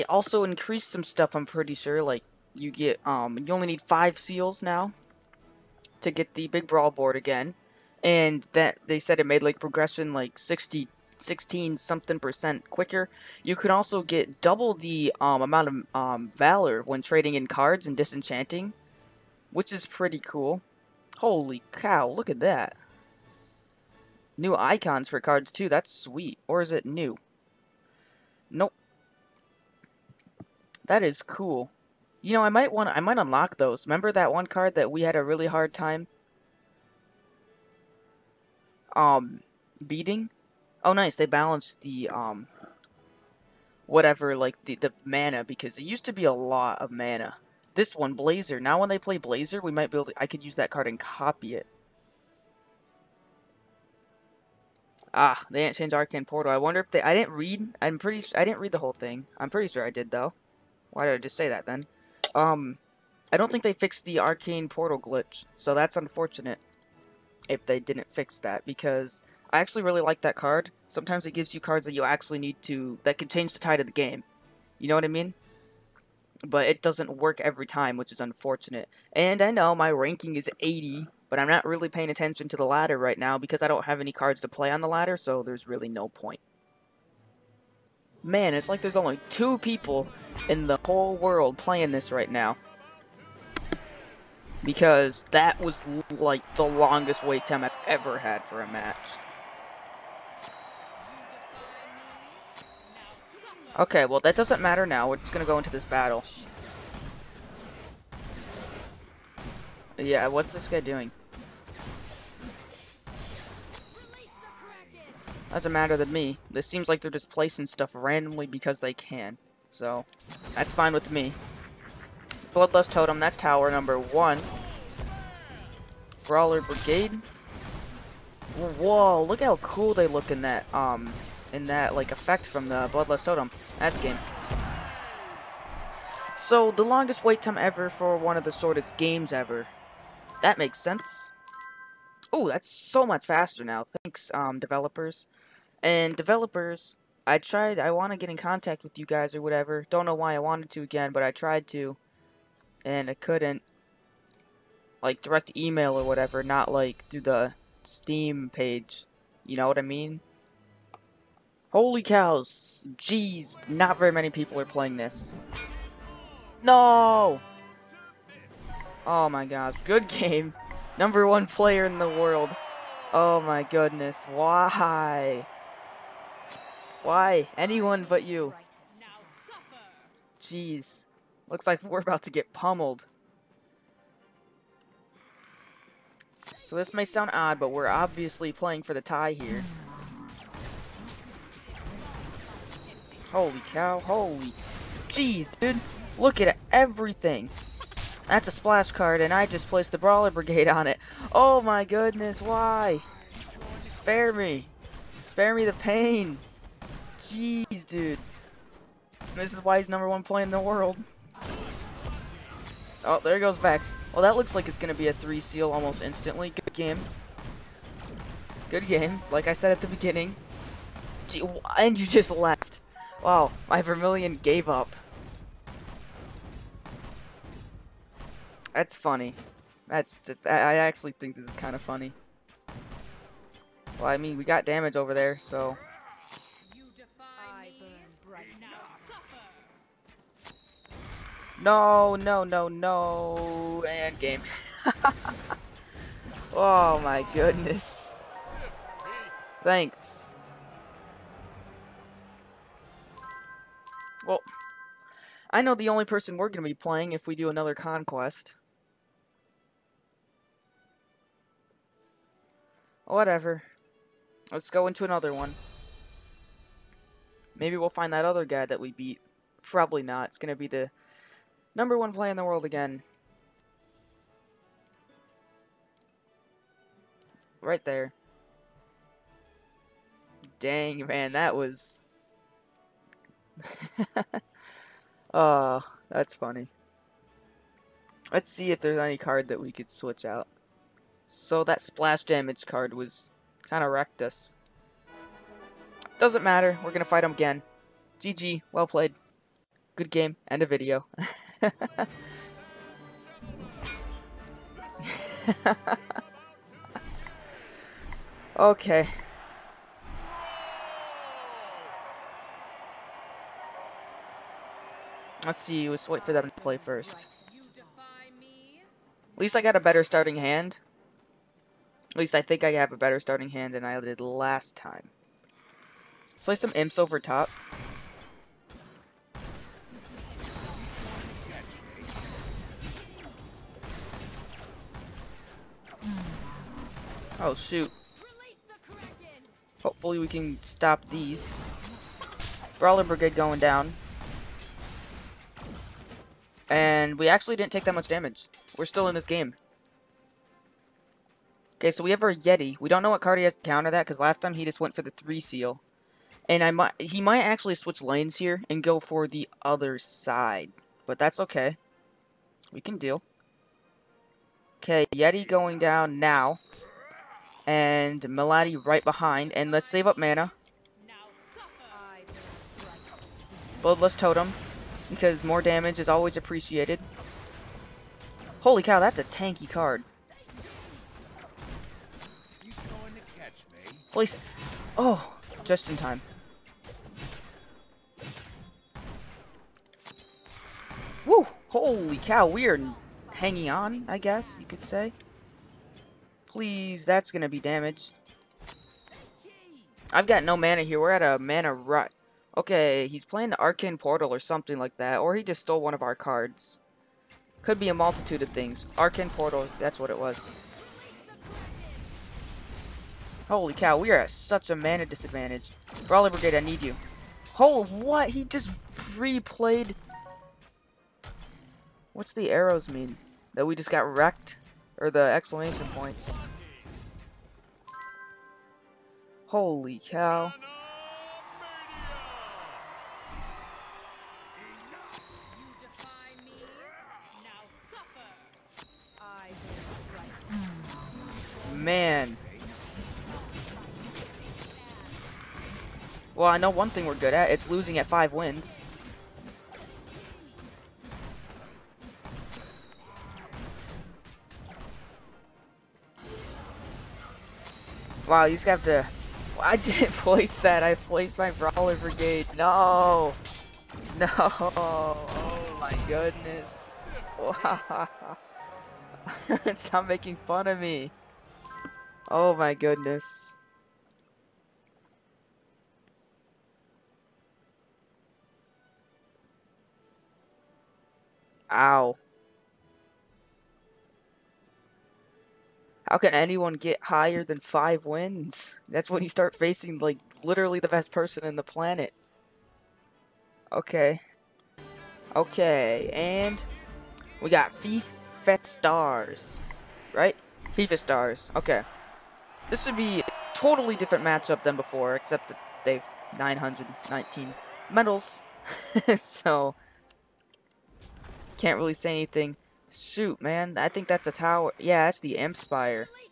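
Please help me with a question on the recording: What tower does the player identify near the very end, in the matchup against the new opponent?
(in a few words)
the Spire.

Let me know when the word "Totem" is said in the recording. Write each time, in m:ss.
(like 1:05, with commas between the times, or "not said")
2:02, 2:13, 6:14.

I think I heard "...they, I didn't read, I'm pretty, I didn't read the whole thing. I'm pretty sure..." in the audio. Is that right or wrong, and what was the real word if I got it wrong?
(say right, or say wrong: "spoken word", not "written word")
right.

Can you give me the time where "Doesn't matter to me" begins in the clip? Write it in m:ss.
1:55.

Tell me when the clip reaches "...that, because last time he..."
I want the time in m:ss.
5:53.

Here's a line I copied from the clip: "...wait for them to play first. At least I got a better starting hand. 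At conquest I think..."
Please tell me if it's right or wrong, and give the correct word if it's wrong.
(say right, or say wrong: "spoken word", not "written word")
wrong: "least", not "conquest".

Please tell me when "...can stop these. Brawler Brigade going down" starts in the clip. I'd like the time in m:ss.
5:40.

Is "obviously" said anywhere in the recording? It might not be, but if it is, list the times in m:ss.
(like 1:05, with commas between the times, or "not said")
3:07.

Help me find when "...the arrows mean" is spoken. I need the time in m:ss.
7:02.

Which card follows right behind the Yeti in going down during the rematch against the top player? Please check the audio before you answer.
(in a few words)
Melody.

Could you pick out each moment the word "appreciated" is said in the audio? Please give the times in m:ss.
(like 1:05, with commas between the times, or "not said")
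6:16.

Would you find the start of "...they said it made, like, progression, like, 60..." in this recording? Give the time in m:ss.
0:08.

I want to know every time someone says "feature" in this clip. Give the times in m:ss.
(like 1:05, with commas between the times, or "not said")
not said.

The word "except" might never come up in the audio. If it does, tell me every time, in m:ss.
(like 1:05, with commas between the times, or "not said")
8:25.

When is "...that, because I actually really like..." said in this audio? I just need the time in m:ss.
1:08.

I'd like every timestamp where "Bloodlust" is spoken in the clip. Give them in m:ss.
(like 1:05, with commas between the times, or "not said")
2:02, 2:12, 6:13.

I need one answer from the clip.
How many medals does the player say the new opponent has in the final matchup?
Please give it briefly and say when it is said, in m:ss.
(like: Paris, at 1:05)
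919, at 8:26.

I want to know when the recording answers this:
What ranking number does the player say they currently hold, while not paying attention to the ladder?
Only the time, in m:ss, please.
1:20.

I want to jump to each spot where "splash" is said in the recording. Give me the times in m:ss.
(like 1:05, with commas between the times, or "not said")
3:18, 4:51.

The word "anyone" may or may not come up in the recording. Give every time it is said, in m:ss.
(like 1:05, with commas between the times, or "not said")
2:57, 8:06.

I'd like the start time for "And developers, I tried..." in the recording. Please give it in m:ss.
2:25.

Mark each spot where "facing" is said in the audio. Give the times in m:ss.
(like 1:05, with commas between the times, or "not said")
8:09.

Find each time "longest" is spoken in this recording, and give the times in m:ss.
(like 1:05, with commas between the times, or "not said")
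1:36, 2:16.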